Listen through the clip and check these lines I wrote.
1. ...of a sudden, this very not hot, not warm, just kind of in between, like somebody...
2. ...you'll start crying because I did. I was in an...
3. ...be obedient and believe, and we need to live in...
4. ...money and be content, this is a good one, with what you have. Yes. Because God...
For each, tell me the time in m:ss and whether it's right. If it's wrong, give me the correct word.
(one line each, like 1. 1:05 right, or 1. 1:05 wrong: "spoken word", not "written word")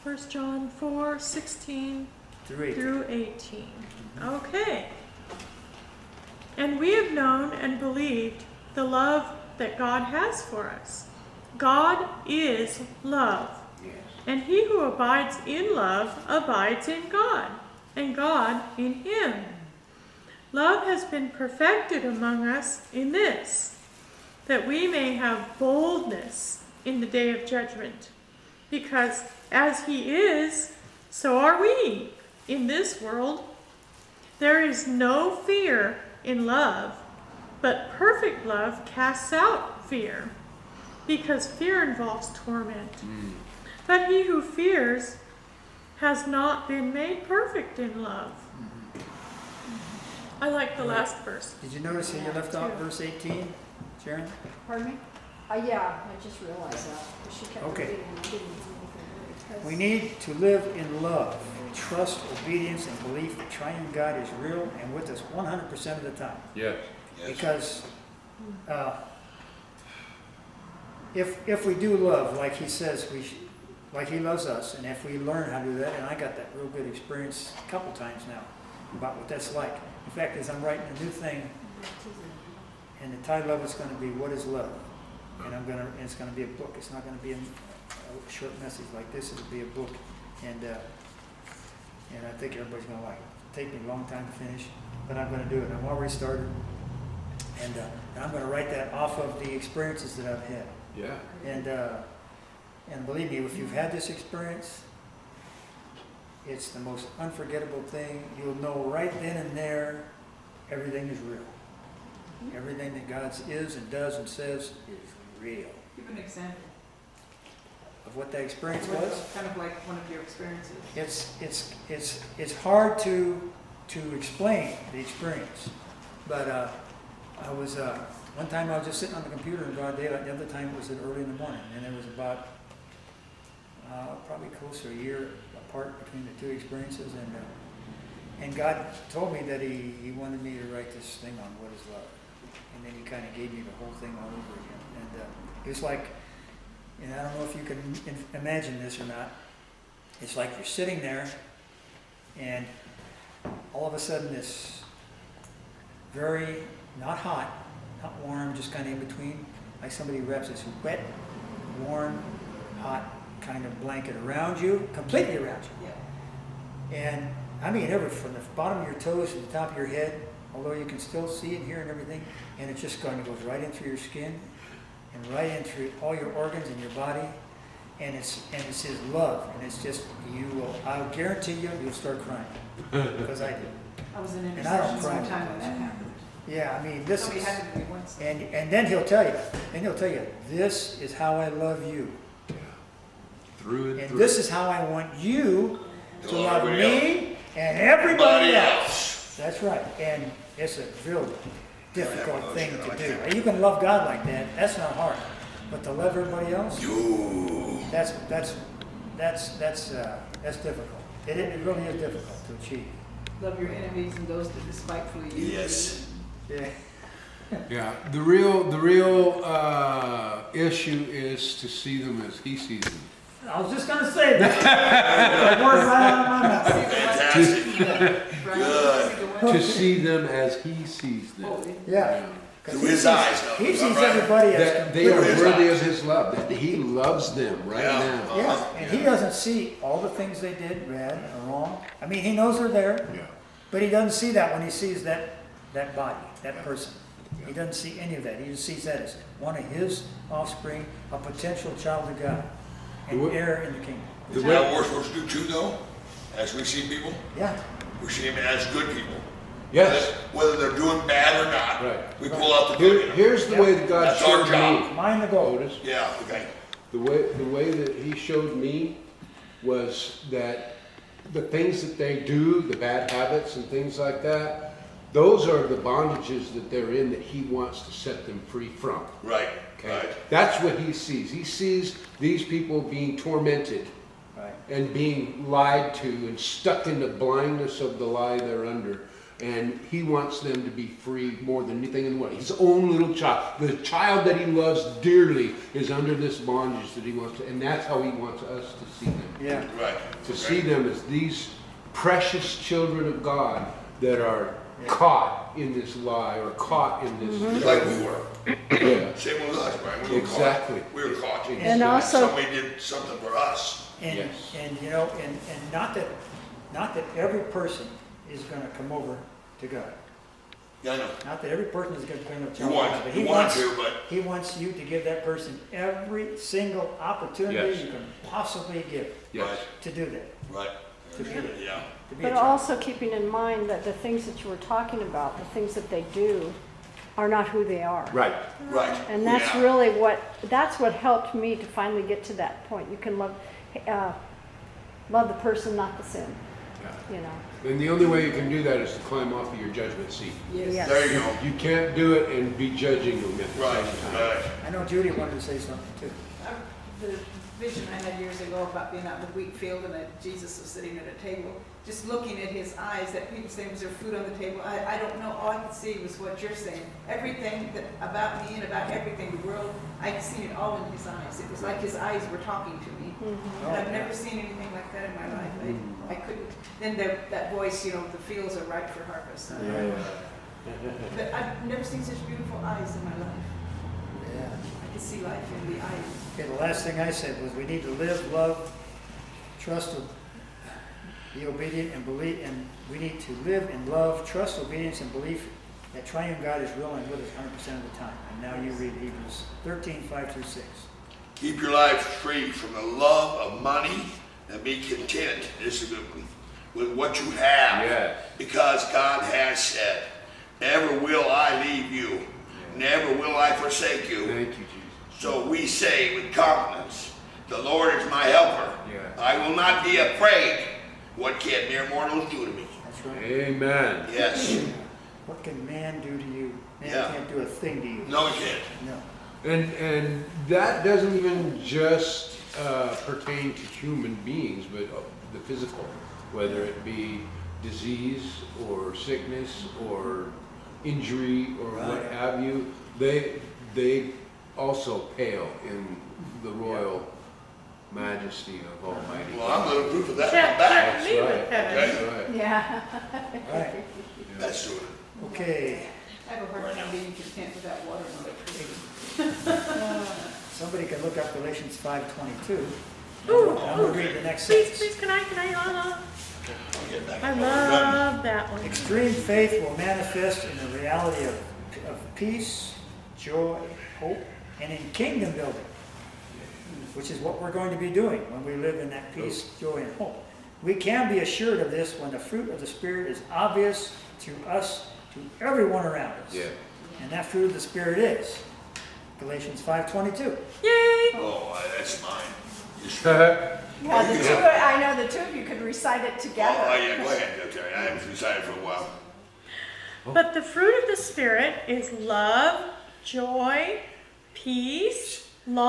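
1. 2:33 right
2. 3:01 right
3. 6:31 right
4. 6:43 right.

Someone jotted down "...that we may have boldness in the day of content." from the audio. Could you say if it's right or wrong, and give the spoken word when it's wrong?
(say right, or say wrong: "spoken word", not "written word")
wrong: "judgment", not "content".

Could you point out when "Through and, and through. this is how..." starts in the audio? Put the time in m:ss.
3:13.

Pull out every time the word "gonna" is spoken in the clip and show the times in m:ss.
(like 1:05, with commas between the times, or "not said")
7:29, 7:43.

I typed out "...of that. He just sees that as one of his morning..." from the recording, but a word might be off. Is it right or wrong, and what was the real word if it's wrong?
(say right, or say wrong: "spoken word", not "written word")
wrong: "offspring", not "morning".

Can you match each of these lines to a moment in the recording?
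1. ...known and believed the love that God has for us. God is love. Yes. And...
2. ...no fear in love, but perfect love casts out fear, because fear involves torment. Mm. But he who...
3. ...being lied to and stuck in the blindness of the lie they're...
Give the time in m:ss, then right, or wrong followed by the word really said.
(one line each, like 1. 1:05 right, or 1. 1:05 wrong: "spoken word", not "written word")
1. 0:07 right
2. 0:34 right
3. 4:44 right.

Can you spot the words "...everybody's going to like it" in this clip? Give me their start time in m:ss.
1:32.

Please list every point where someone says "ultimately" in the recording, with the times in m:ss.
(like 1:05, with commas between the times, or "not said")
not said.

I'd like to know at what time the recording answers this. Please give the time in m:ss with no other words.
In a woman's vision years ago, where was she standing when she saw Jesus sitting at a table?
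5:59.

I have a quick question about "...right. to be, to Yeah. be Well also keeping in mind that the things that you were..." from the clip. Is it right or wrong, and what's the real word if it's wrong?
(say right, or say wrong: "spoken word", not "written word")
wrong: "But", not "Well".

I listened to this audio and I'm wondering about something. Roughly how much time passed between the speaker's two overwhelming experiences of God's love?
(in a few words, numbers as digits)
close to a year.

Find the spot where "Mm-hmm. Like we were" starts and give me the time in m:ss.
5:07.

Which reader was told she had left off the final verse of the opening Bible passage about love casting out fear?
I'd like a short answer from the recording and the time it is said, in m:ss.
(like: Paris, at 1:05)
Sharron, at 0:54.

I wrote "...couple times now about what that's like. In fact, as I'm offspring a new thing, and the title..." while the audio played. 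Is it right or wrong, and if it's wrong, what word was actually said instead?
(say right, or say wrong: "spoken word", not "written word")
wrong: "writing", not "offspring".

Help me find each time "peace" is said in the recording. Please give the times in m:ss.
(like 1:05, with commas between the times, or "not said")
7:52, 7:59, 8:24.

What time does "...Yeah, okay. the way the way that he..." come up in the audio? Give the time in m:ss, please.
4:25.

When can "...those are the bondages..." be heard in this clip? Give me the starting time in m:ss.
4:35.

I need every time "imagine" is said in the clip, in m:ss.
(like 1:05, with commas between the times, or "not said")
2:28.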